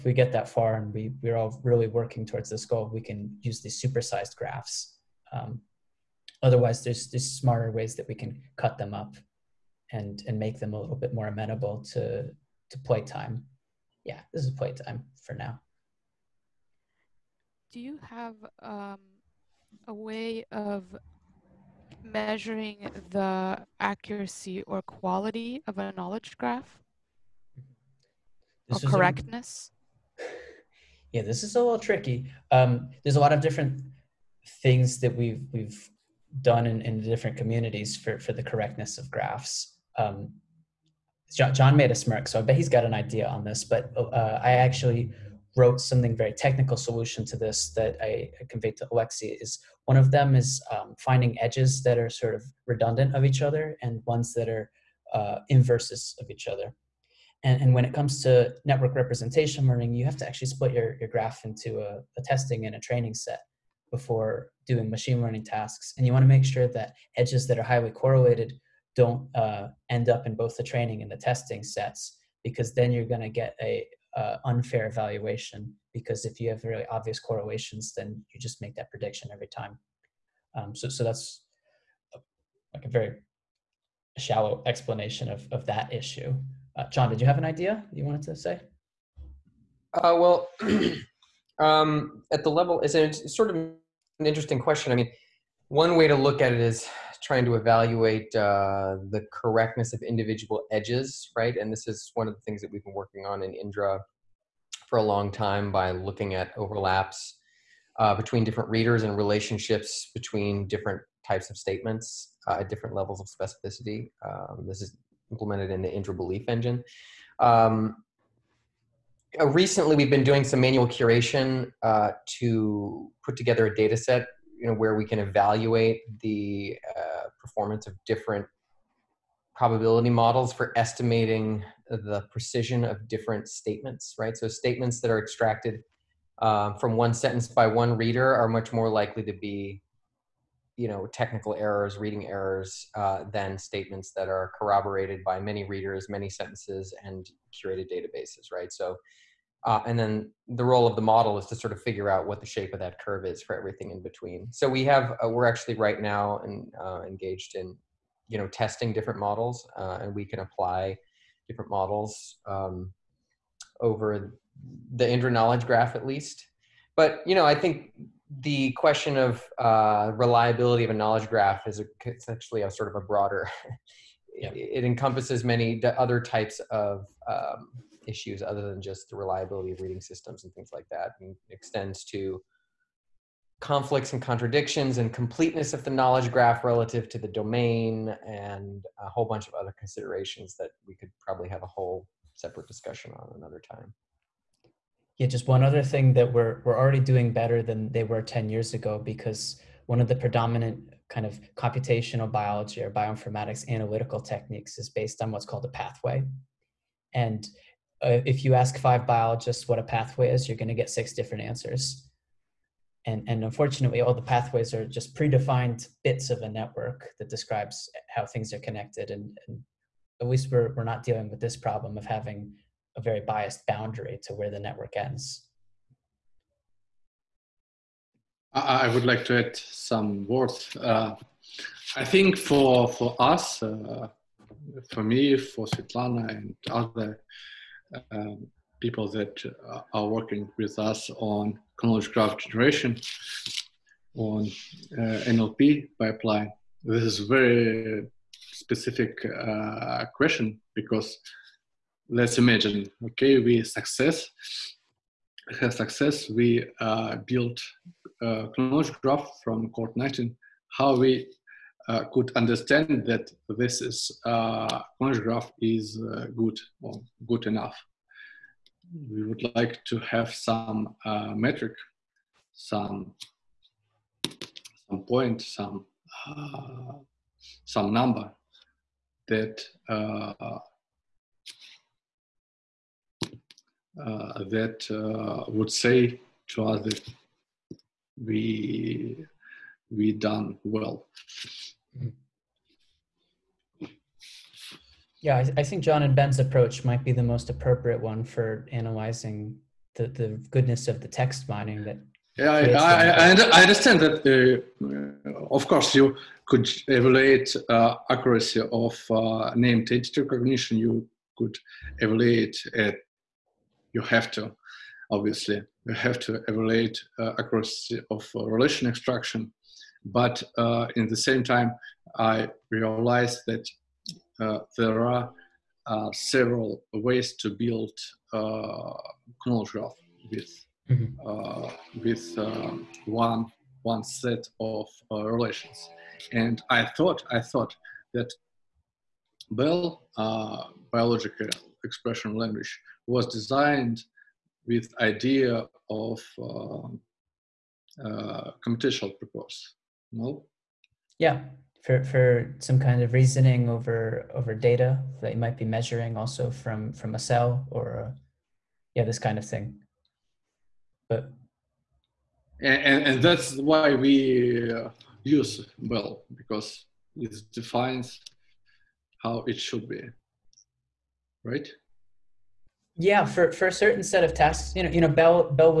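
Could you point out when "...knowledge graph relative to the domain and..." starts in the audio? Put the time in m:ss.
3:05.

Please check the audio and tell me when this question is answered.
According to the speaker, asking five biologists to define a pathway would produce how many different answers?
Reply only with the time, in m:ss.
3:30.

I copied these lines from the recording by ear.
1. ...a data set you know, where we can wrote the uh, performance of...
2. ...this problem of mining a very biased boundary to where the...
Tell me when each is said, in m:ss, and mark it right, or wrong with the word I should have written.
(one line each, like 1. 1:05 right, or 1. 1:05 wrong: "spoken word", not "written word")
1. 2:03 wrong: "evaluate", not "wrote"
2. 3:41 wrong: "having", not "mining".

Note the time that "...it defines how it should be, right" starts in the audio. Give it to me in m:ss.
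6:07.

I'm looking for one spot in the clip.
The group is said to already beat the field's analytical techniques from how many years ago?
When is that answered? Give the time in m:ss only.
3:18.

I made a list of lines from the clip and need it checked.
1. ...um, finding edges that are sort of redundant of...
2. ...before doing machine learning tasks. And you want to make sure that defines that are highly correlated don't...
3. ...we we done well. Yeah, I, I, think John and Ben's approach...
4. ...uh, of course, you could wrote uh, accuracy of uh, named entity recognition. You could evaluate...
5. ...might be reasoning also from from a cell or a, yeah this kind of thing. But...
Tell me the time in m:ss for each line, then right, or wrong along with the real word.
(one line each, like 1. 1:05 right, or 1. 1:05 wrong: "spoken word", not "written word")
1. 0:50 right
2. 1:03 wrong: "edges", not "defines"
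3. 4:48 right
4. 5:05 wrong: "evaluate", not "wrote"
5. 5:55 wrong: "measuring", not "reasoning".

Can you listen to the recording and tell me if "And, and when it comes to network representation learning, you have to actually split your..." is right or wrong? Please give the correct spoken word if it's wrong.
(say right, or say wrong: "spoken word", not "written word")
right.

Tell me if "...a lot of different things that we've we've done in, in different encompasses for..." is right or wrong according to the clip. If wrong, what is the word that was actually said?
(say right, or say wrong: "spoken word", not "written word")
wrong: "communities", not "encompasses".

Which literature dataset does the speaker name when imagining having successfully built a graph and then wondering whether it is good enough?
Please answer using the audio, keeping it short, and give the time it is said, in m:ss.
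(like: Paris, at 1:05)
CORD19, at 4:19.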